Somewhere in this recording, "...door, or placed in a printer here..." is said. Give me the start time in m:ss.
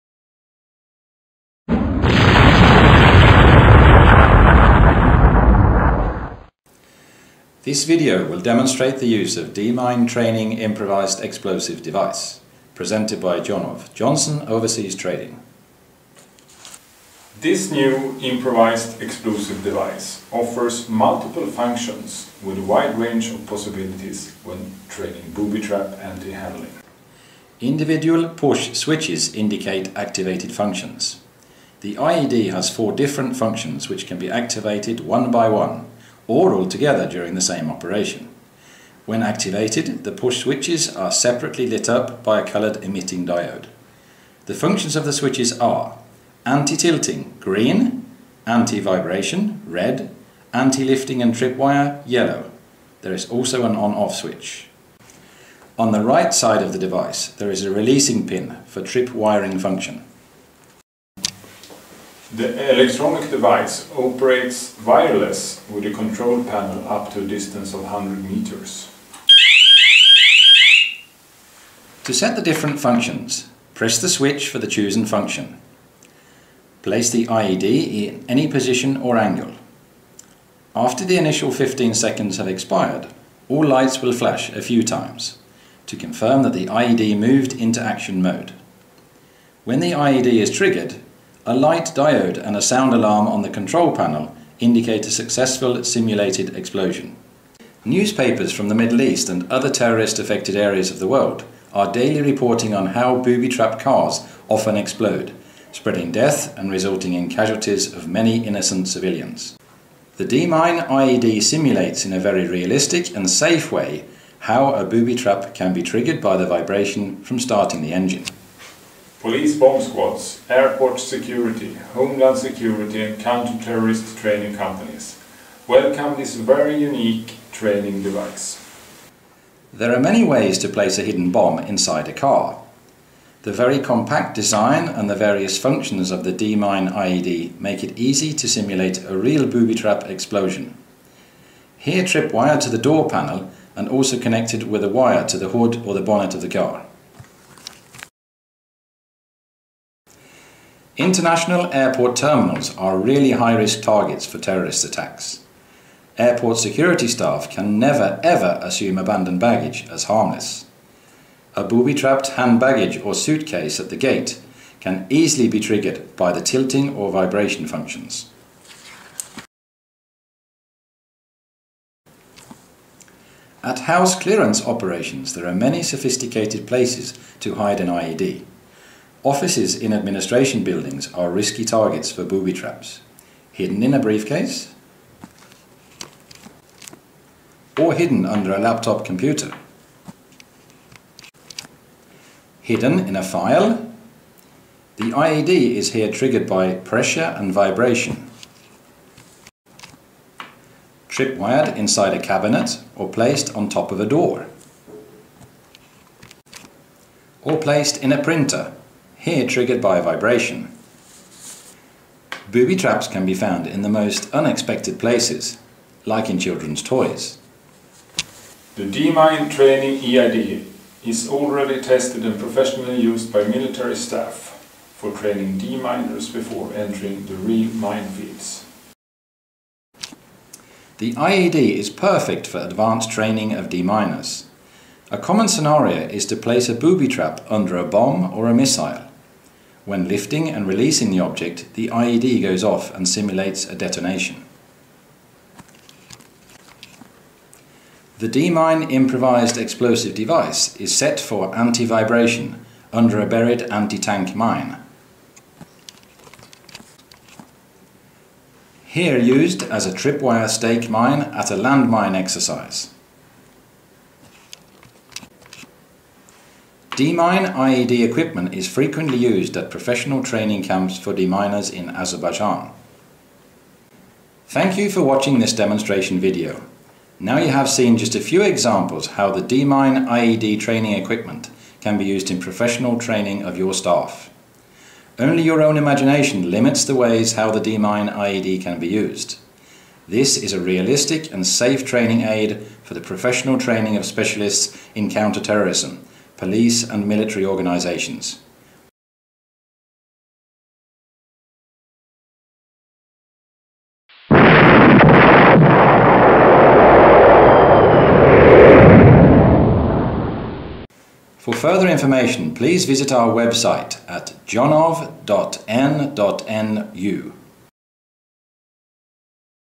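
3:24.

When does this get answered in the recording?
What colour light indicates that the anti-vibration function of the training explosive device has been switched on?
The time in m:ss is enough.
0:49.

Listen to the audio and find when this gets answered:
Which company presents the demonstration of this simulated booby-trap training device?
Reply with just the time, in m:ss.
0:13.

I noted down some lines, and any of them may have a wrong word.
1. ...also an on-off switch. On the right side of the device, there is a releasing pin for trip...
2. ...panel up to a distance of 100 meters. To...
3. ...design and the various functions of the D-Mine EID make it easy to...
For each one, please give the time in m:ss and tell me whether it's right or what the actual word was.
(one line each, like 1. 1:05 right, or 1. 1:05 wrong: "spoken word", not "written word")
1. 0:53 right
2. 1:06 right
3. 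2:14 wrong: "IED", not "EID".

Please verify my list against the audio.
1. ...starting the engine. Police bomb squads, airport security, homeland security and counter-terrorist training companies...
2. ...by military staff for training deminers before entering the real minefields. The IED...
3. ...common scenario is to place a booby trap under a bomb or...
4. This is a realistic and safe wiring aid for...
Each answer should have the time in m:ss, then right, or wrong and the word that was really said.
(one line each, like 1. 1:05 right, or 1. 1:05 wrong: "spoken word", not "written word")
1. 1:57 right
2. 3:43 right
3. 3:55 right
4. 4:50 wrong: "training", not "wiring".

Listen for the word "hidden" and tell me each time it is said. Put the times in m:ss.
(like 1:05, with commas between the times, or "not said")
2:11, 3:03, 3:07, 3:12.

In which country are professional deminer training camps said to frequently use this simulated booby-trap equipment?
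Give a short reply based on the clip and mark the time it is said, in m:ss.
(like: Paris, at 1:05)
Azerbaijan, at 4:31.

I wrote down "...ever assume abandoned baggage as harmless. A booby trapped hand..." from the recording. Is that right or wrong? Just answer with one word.
right.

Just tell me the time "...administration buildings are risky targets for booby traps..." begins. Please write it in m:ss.
2:59.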